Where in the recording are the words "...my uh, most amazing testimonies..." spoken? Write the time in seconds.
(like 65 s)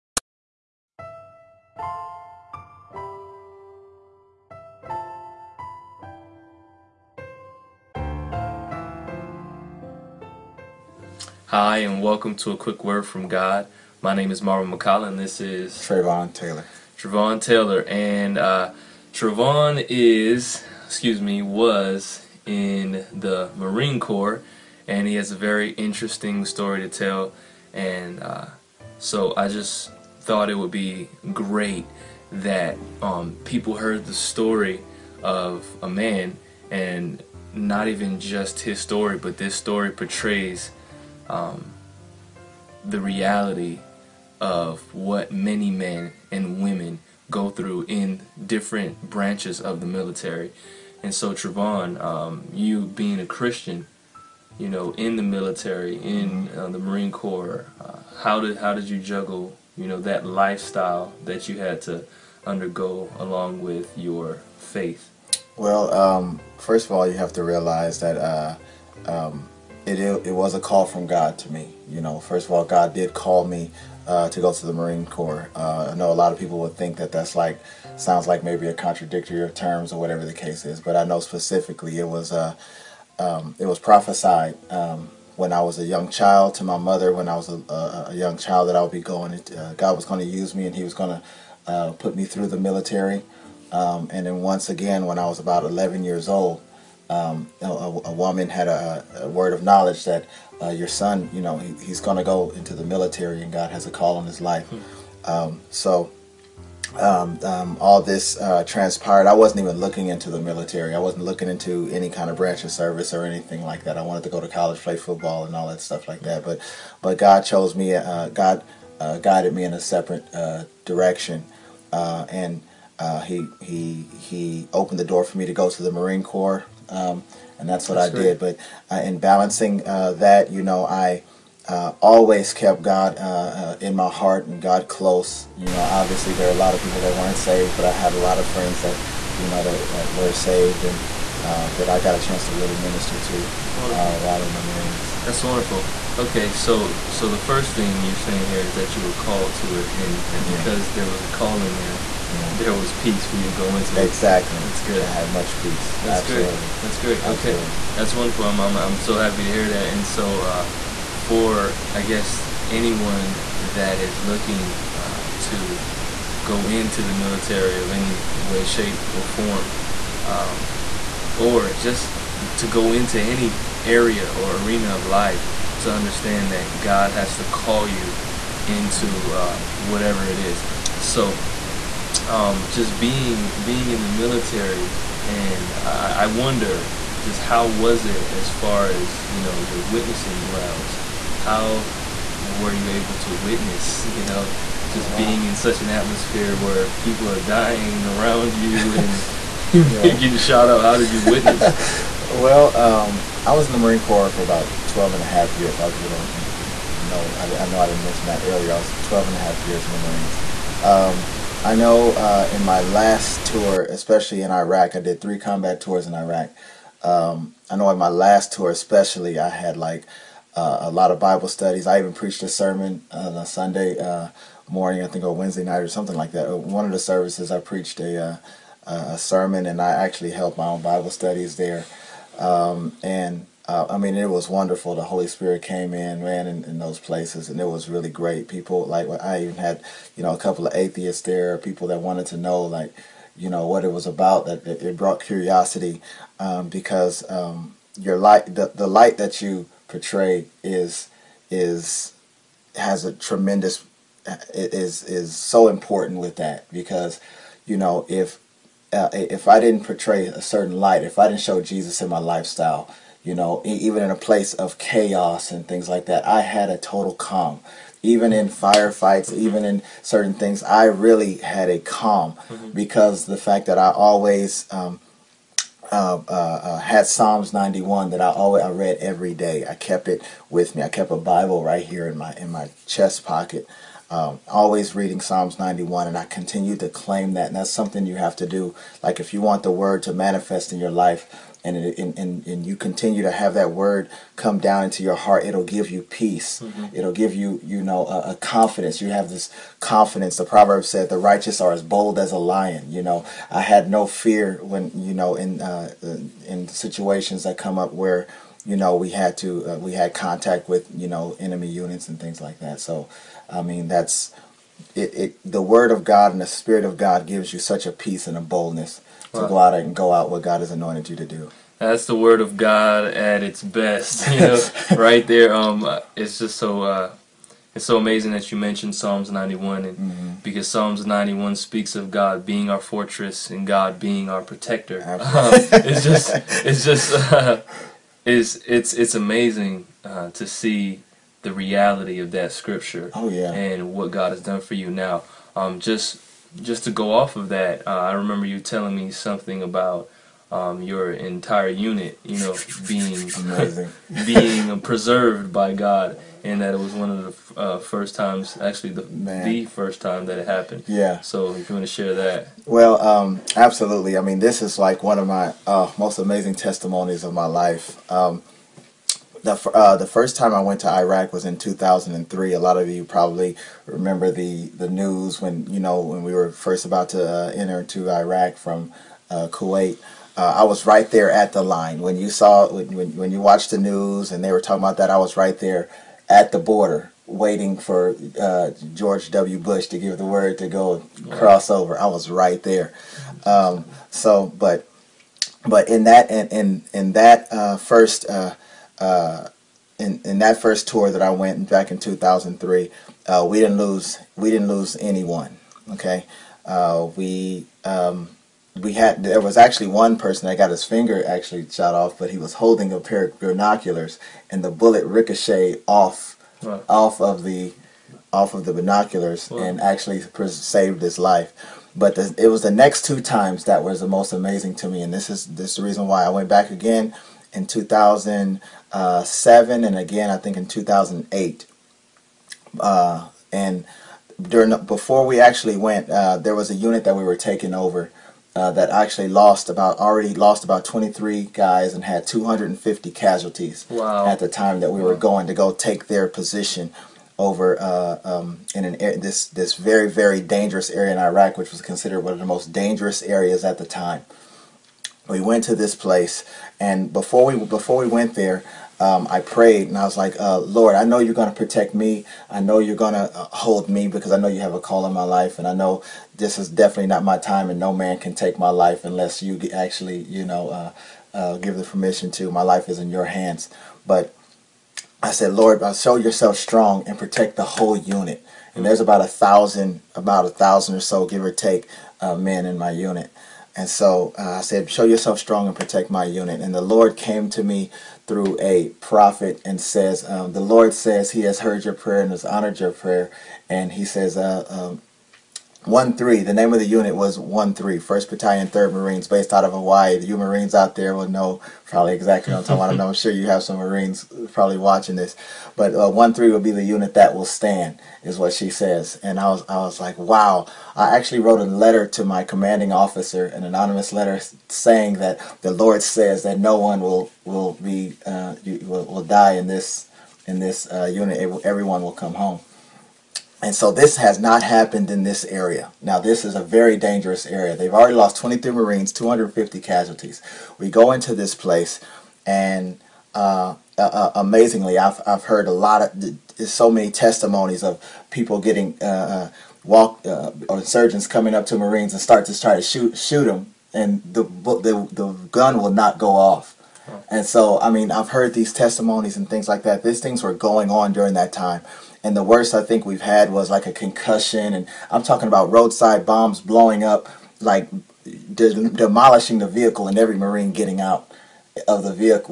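365 s.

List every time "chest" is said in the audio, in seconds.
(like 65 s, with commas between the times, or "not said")
282 s.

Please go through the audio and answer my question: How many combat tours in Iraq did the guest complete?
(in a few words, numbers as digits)
Three.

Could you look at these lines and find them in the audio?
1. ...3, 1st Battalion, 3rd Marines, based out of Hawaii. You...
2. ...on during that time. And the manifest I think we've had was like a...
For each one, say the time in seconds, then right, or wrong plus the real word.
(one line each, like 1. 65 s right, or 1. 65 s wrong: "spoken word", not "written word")
1. 497 s right
2. 550 s wrong: "worst", not "manifest".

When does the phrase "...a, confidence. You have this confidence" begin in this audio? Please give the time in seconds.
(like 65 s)
298 s.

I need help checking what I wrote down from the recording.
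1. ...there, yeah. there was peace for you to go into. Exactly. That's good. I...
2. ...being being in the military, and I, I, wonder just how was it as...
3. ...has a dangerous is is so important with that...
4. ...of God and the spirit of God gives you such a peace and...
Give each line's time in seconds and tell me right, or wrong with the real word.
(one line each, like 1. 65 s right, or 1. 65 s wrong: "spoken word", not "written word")
1. 151 s right
2. 182 s right
3. 252 s wrong: "tremendous", not "dangerous"
4. 315 s right.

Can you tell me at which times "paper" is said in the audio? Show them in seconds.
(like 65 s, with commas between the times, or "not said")
not said.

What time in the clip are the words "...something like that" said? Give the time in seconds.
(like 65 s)
225 s.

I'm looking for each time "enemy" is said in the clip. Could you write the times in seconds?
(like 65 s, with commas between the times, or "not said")
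311 s.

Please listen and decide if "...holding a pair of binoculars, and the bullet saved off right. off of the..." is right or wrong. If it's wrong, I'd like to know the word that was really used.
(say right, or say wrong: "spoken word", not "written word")
wrong: "ricocheted", not "saved".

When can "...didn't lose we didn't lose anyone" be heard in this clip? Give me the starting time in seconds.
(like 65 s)
403 s.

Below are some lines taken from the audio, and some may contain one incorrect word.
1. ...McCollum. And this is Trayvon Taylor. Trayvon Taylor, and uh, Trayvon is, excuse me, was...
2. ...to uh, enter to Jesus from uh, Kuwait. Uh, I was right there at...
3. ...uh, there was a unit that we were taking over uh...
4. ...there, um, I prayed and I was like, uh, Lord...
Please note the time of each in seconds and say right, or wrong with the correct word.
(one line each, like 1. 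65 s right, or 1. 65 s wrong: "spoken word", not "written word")
1. 14 s right
2. 377 s wrong: "Iraq", not "Jesus"
3. 436 s right
4. 458 s right.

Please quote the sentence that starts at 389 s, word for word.
Bush to give the word to go cross over.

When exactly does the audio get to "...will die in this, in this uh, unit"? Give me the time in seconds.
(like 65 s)
519 s.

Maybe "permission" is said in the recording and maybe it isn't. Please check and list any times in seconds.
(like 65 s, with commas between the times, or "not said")
471 s.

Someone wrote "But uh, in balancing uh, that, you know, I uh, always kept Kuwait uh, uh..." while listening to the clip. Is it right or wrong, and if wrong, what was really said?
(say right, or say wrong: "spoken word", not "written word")
wrong: "God", not "Kuwait".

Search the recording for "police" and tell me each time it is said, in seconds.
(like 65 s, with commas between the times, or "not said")
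not said.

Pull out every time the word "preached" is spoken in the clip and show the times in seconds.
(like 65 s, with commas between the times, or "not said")
222 s, 227 s.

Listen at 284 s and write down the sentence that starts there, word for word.
Um, always reading Psalms 91, and I continue to claim that.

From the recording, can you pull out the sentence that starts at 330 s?
because Psalms 91 speaks of God being our fortress and God being our protector.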